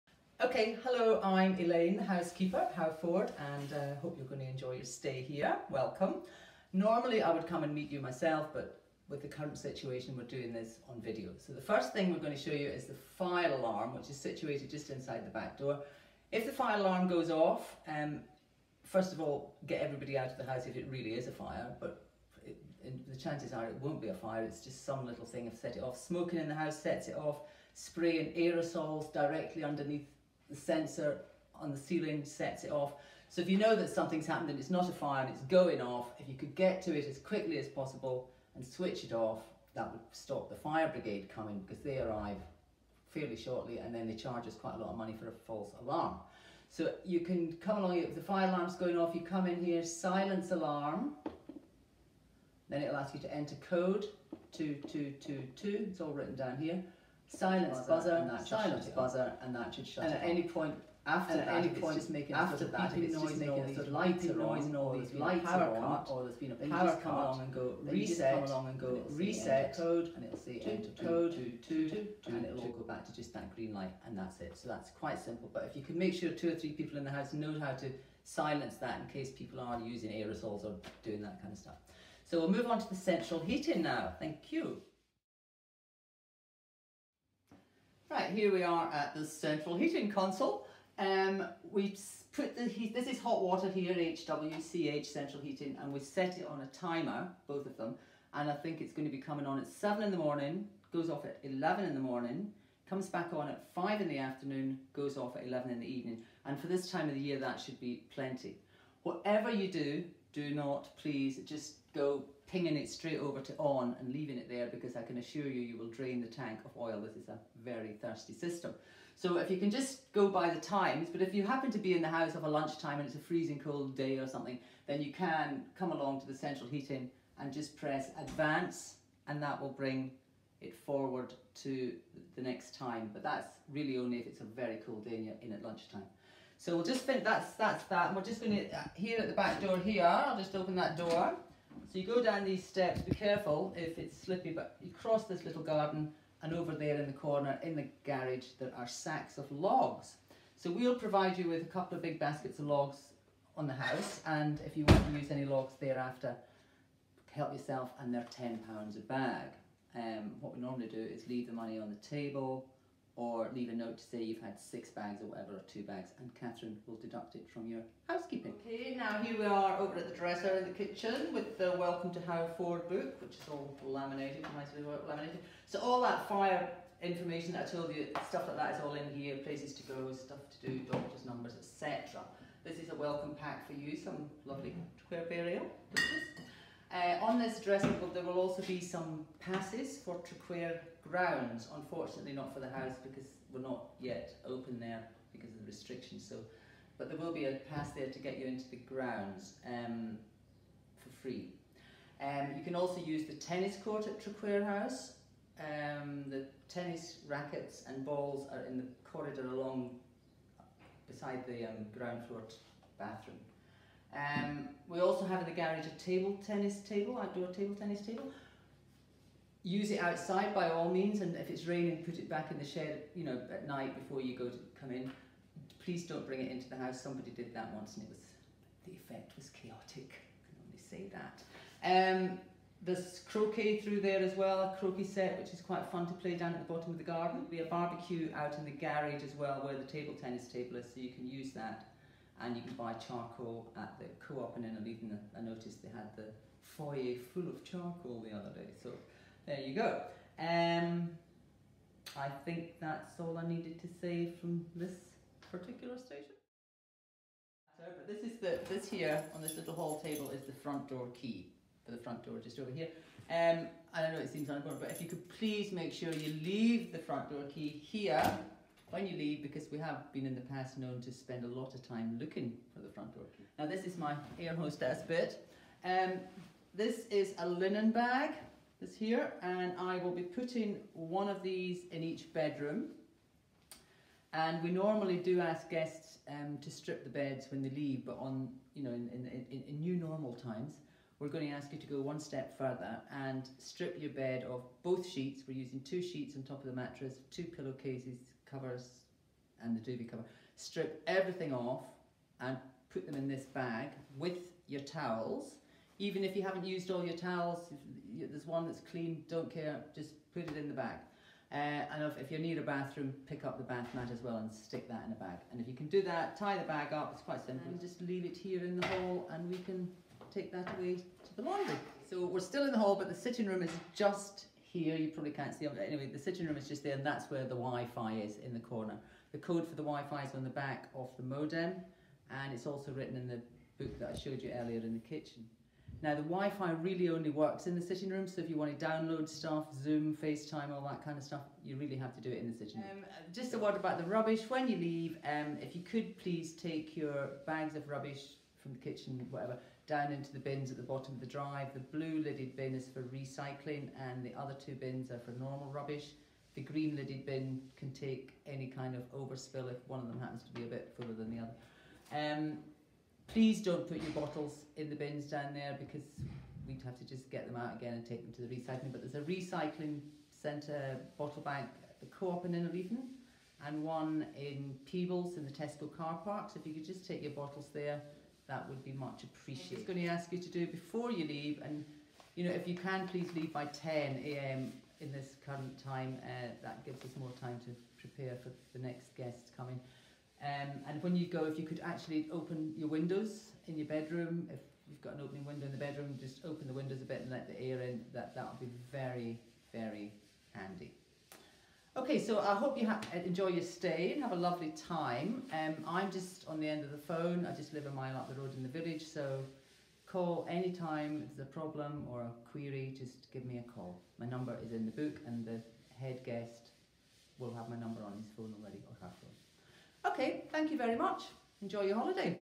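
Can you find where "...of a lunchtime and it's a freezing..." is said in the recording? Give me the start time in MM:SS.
02:02.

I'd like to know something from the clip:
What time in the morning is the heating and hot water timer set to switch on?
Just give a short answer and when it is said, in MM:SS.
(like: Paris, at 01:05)
7, at 01:39.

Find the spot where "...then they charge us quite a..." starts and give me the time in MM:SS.
00:43.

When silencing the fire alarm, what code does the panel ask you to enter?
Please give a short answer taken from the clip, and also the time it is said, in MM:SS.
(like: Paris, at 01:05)
2222, at 00:54.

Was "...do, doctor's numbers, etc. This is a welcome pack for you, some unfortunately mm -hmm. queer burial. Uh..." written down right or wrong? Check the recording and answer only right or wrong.
wrong.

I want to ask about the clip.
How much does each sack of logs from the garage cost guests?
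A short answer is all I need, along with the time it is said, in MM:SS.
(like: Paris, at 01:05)
£10, at 02:38.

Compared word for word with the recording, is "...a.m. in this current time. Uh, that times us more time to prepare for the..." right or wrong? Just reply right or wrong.
wrong.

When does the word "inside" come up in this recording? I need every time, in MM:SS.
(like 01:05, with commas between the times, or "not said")
00:14.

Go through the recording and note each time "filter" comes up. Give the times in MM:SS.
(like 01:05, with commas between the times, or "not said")
not said.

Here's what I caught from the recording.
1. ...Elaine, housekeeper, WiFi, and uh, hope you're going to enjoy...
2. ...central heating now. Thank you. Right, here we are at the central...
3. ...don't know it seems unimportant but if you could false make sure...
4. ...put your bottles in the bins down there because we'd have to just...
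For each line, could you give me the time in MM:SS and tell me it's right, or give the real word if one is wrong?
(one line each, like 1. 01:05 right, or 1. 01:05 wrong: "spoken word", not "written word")
1. 00:01 wrong: "Howford", not "WiFi"
2. 01:22 right
3. 04:24 wrong: "please", not "false"
4. 06:03 right.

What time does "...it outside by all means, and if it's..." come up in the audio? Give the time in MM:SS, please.
03:39.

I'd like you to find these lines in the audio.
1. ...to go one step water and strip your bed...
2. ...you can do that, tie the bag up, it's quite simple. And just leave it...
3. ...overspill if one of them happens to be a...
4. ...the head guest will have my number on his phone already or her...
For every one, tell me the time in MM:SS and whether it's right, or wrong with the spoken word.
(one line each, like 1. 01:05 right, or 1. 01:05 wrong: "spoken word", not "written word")
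1. 04:51 wrong: "further", not "water"
2. 05:15 right
3. 05:59 right
4. 06:55 right.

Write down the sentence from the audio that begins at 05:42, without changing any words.
Um, uh, just a word about the rubbish.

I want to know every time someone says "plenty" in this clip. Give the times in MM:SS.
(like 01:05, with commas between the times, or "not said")
01:48.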